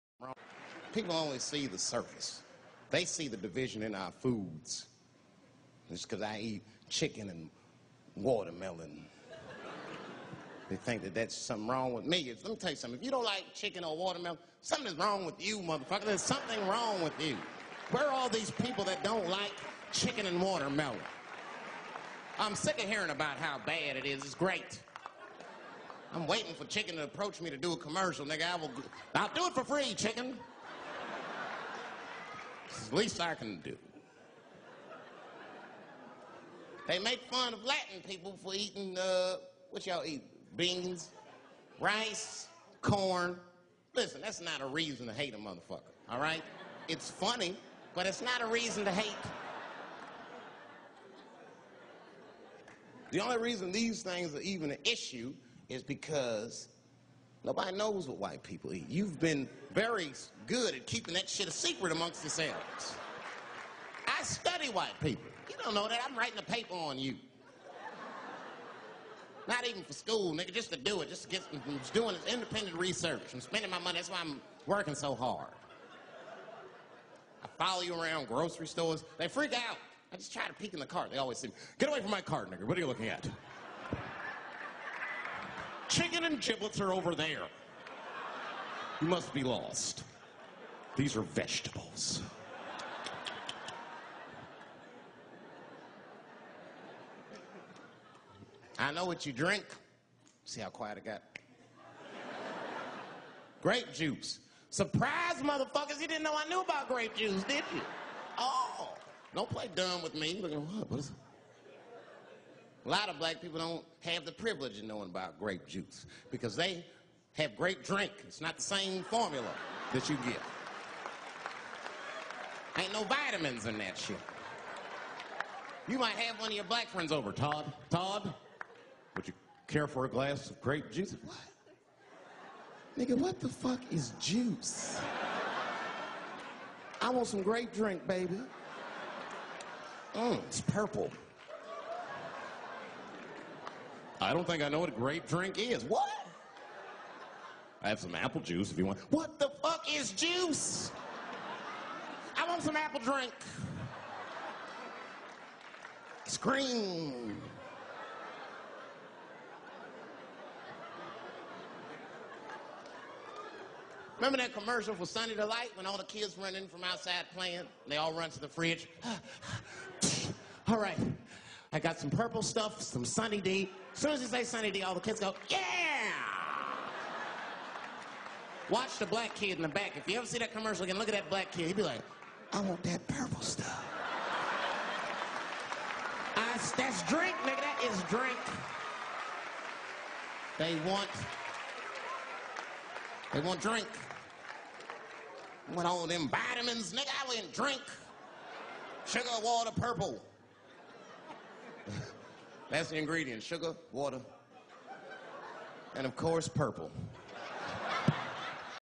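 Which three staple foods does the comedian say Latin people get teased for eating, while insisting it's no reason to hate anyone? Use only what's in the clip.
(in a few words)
Beans, rice, corn.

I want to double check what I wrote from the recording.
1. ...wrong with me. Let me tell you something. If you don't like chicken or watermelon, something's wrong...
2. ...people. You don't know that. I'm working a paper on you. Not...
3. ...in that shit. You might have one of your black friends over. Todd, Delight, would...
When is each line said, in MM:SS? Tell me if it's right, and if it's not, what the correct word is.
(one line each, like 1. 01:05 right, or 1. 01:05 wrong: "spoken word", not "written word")
1. 00:11 right
2. 01:05 wrong: "writing", not "working"
3. 02:03 wrong: "Todd", not "Delight".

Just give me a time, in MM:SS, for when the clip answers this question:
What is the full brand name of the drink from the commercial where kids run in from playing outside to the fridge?
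02:45.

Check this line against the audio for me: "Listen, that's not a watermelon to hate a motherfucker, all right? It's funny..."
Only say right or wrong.
wrong.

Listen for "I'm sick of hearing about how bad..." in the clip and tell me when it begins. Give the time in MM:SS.
00:22.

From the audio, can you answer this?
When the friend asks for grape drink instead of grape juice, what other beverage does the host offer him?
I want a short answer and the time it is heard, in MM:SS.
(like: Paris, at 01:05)
apple juice, at 02:28.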